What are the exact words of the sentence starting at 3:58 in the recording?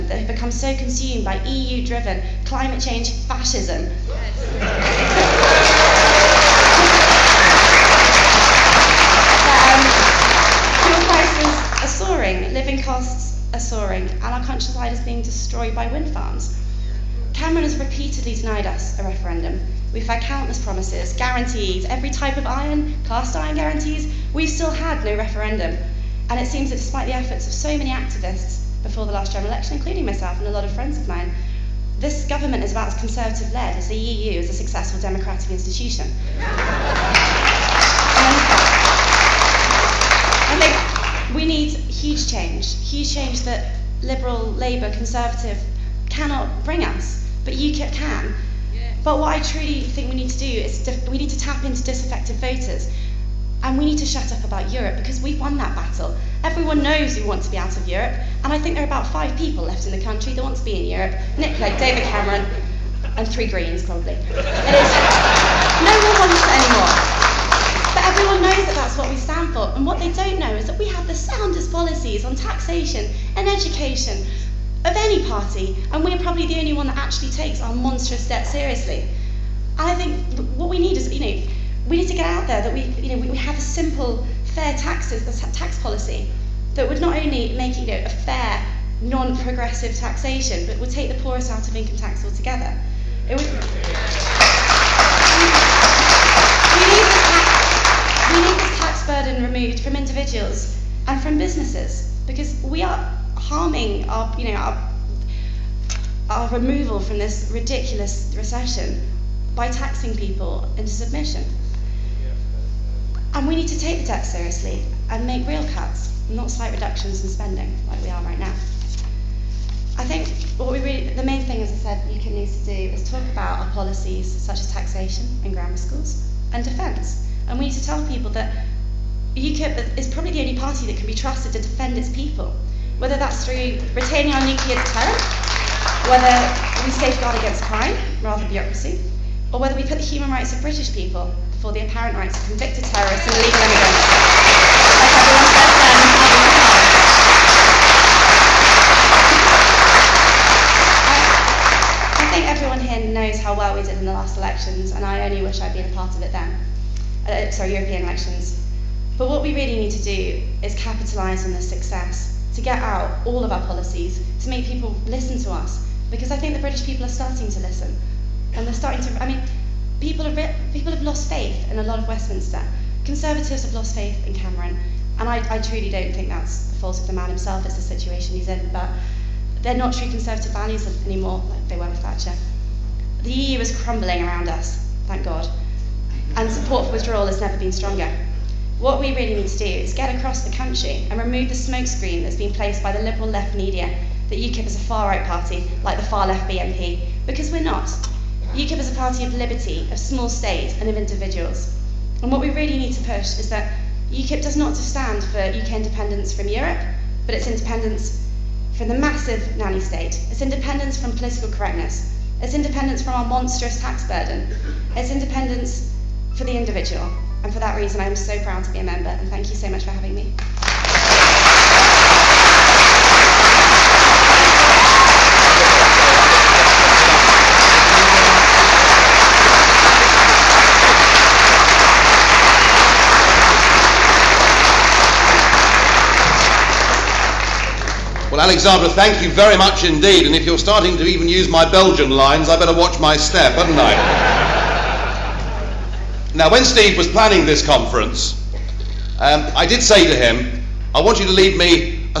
Well, Alexandra, thank you very much indeed.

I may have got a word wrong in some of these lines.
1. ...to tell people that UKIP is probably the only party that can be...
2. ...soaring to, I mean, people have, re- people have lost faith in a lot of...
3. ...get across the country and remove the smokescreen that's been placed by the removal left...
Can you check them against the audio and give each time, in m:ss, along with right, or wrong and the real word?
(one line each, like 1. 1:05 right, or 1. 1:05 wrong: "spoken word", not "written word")
1. 2:07 right
2. 2:48 wrong: "starting", not "soaring"
3. 3:09 wrong: "liberal", not "removal".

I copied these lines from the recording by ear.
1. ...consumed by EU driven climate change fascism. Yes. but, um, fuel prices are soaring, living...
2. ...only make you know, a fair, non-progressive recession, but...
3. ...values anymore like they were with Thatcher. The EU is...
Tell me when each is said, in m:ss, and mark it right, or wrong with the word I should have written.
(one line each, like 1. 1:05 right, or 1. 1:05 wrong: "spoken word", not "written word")
1. 0:00 right
2. 1:27 wrong: "taxation", not "recession"
3. 3:00 right.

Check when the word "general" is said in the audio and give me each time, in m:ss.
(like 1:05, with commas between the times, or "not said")
0:29.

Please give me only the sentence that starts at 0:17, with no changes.
Cameron has repeatedly denied us a referendum.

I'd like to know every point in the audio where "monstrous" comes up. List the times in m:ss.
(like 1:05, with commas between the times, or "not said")
1:17, 3:33.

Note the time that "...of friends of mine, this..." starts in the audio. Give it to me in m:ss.
0:30.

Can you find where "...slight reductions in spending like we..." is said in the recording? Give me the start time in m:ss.
1:56.